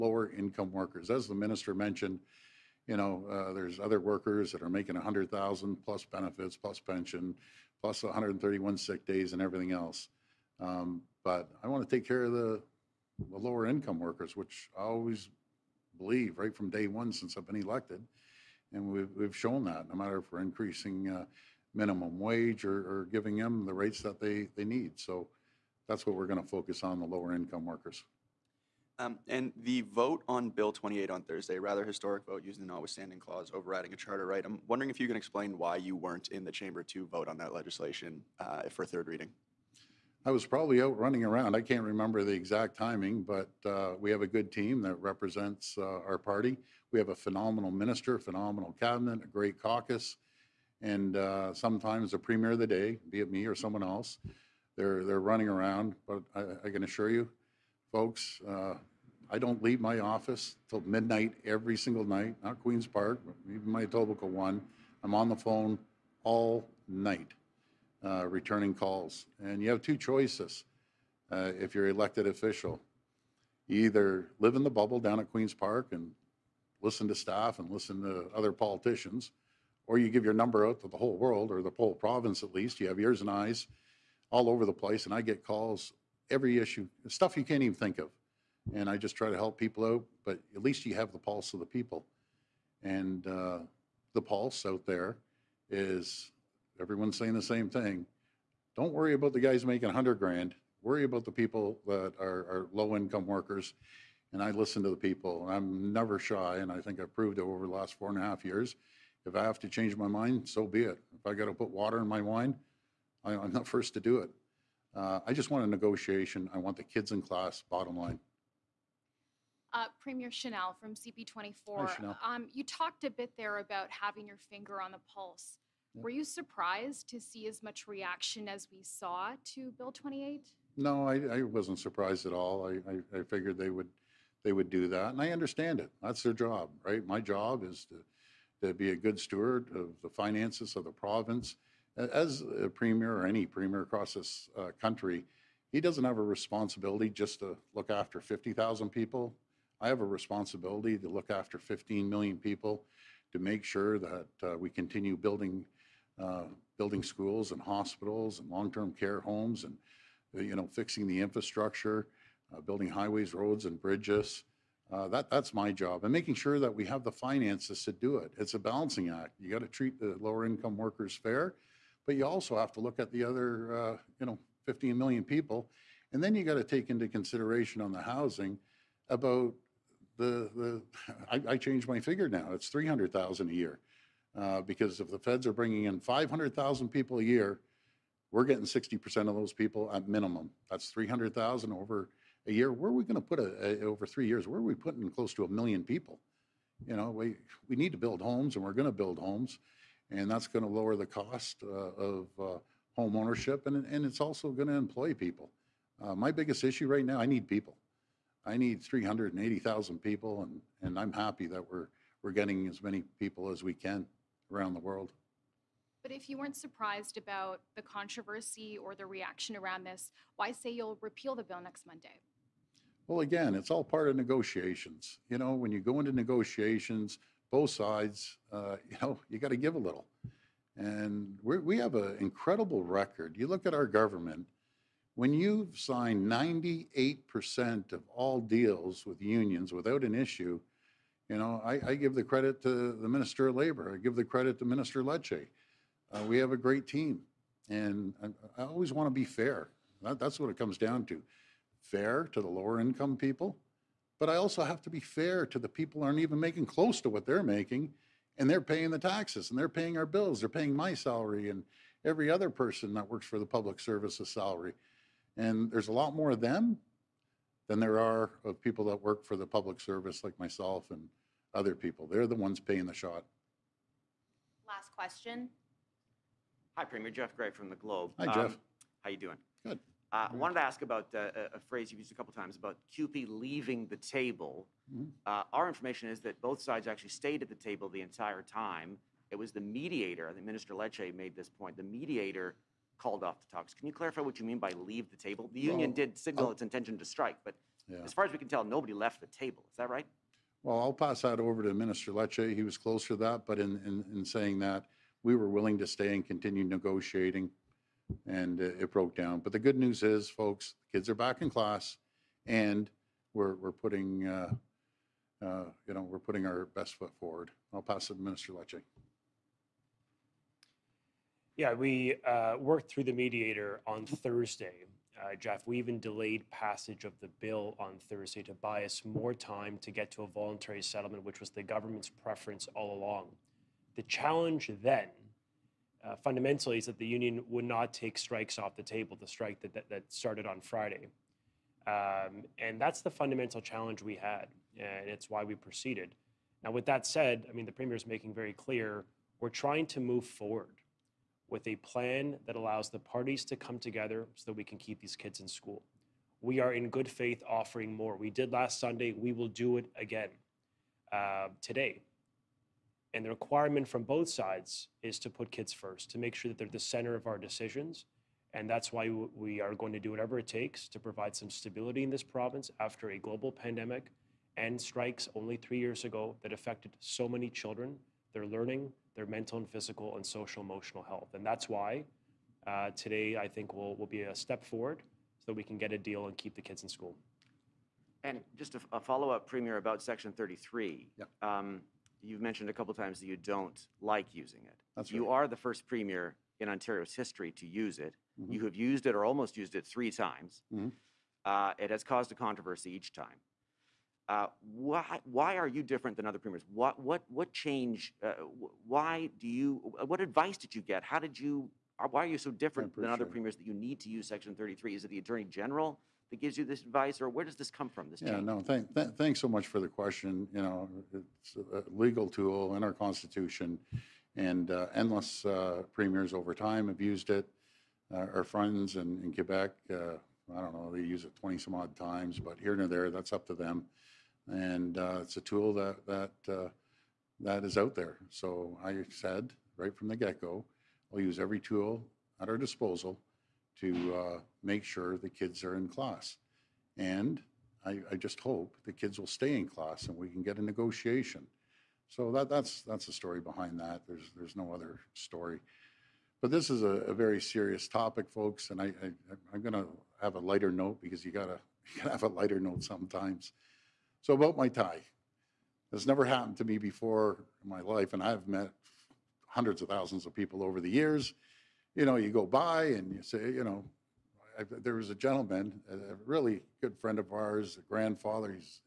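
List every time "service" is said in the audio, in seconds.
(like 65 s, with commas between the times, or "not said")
263 s, 269 s.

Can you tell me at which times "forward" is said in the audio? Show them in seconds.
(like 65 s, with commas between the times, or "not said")
317 s, 350 s, 384 s.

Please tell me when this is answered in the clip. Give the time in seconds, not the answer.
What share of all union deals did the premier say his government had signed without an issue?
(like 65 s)
236 s.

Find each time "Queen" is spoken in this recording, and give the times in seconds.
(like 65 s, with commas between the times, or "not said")
62 s, 75 s.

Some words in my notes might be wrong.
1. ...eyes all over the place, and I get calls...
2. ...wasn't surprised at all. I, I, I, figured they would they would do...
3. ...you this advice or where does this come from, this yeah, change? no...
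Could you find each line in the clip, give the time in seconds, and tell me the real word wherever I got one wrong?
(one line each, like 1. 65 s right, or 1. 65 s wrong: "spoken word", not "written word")
1. 83 s right
2. 131 s right
3. 416 s right.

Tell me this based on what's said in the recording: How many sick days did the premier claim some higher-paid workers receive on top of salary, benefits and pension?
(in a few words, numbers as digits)
131.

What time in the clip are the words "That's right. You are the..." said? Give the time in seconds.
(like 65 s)
394 s.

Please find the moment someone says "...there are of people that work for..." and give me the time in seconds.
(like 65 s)
267 s.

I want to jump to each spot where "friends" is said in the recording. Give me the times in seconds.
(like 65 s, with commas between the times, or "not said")
428 s, 476 s.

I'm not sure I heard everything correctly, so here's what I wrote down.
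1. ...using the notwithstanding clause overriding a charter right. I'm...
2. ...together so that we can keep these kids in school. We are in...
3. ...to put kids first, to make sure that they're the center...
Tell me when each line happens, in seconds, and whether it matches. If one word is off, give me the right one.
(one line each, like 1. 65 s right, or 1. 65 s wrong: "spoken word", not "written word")
1. 32 s right
2. 353 s right
3. 365 s right.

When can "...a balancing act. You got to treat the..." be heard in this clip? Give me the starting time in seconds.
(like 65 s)
168 s.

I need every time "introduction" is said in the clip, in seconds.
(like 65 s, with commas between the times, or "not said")
not said.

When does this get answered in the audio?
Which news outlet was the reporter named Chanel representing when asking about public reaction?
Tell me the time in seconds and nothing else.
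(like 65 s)
120 s.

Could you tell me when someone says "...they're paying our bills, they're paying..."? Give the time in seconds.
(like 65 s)
259 s.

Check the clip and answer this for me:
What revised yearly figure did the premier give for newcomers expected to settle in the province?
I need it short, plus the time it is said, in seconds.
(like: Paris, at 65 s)
300,000, at 182 s.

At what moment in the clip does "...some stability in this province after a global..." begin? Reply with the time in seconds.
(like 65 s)
371 s.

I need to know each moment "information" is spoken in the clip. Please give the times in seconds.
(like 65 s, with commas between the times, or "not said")
285 s.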